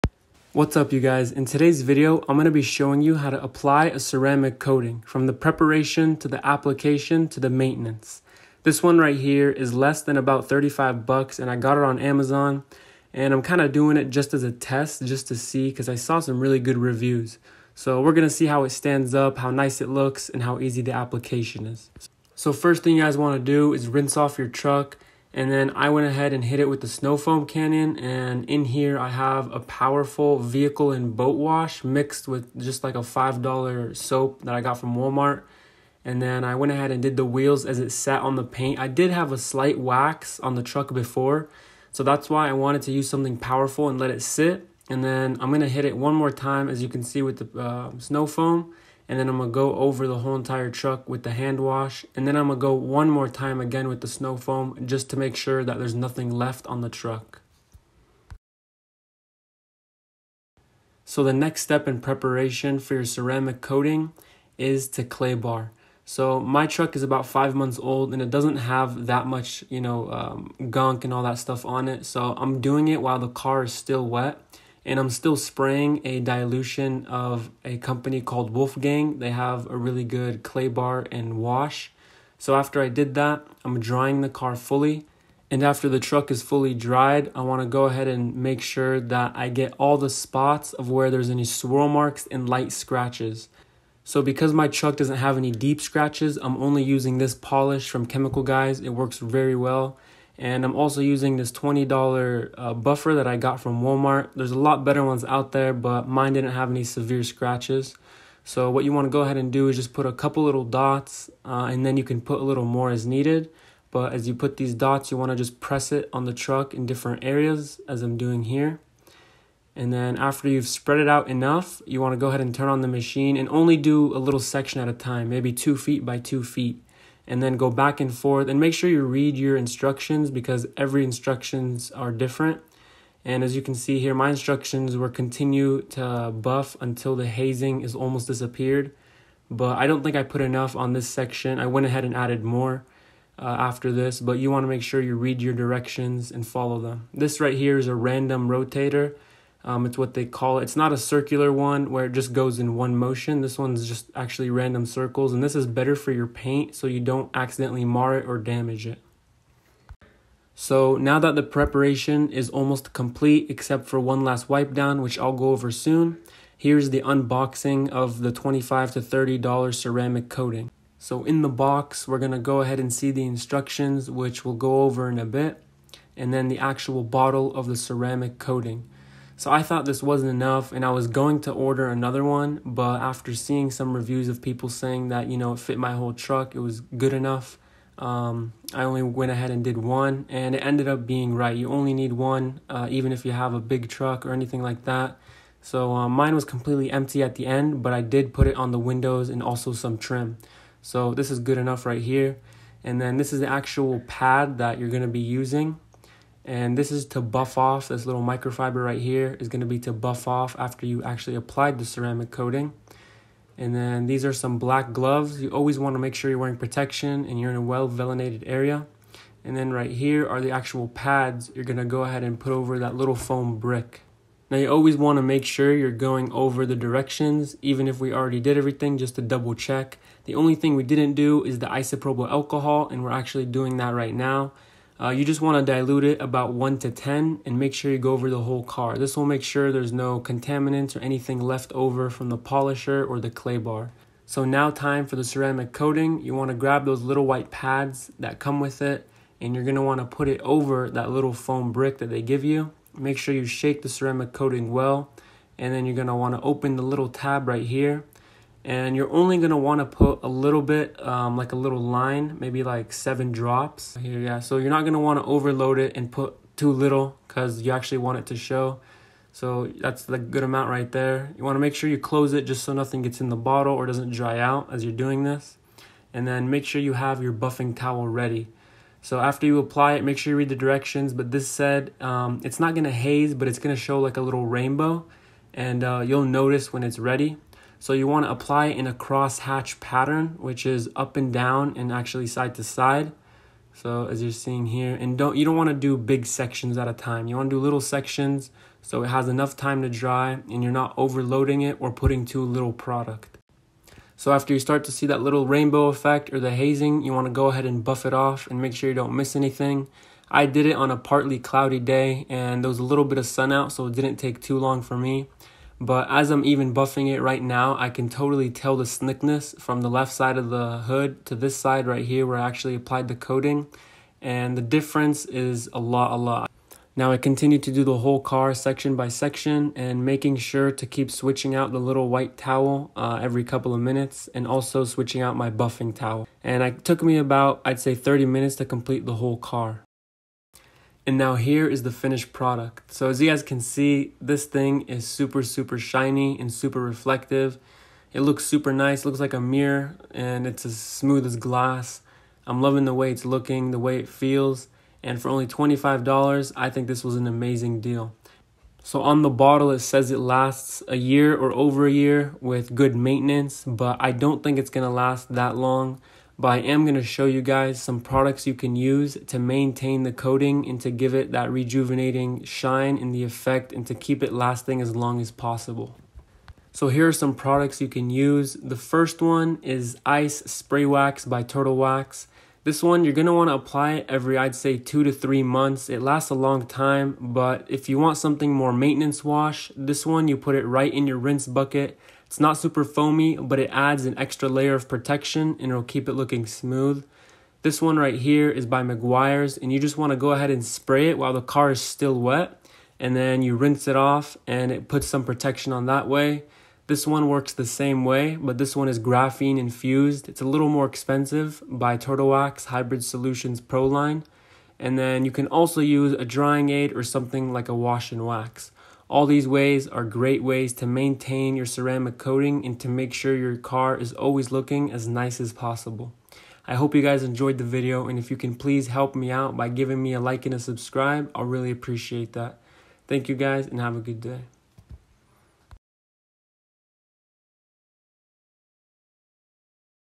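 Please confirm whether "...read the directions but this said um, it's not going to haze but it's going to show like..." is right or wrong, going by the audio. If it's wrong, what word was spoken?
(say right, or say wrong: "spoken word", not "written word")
right.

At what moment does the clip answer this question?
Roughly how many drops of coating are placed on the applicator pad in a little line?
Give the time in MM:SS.
04:22.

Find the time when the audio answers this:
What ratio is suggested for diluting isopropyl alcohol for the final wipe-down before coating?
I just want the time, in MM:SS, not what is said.
03:56.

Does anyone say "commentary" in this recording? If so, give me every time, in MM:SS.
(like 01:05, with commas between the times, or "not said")
not said.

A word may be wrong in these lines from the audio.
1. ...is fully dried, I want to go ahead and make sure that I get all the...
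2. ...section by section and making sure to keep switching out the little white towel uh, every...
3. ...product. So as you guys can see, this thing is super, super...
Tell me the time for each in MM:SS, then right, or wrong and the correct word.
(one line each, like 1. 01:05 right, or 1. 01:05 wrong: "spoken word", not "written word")
1. 01:26 right
2. 05:28 right
3. 05:42 right.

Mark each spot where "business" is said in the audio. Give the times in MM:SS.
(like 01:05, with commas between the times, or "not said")
not said.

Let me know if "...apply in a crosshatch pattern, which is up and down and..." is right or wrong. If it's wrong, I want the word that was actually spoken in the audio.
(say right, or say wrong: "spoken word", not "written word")
right.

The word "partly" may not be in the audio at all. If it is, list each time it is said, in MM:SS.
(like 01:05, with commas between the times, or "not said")
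05:10.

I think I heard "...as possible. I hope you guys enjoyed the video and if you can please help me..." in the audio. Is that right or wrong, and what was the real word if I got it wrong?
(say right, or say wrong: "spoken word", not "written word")
right.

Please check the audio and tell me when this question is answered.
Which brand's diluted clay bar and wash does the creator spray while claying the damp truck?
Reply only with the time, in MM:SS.
01:18.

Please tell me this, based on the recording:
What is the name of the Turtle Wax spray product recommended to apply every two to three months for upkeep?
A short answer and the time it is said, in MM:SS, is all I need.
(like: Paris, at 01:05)
Ice Spray Wax, at 06:20.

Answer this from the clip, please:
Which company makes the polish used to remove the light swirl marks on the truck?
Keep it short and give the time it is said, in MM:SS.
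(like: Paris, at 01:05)
Chemical Guys, at 01:38.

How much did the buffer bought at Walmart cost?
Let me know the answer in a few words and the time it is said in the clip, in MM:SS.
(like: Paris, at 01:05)
$20, at 01:41.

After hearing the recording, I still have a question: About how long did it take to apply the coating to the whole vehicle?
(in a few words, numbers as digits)
30 minutes.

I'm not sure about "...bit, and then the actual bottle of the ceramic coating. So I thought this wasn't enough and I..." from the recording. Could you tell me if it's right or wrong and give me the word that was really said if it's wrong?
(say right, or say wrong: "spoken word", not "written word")
right.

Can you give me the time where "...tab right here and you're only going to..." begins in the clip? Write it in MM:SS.
04:17.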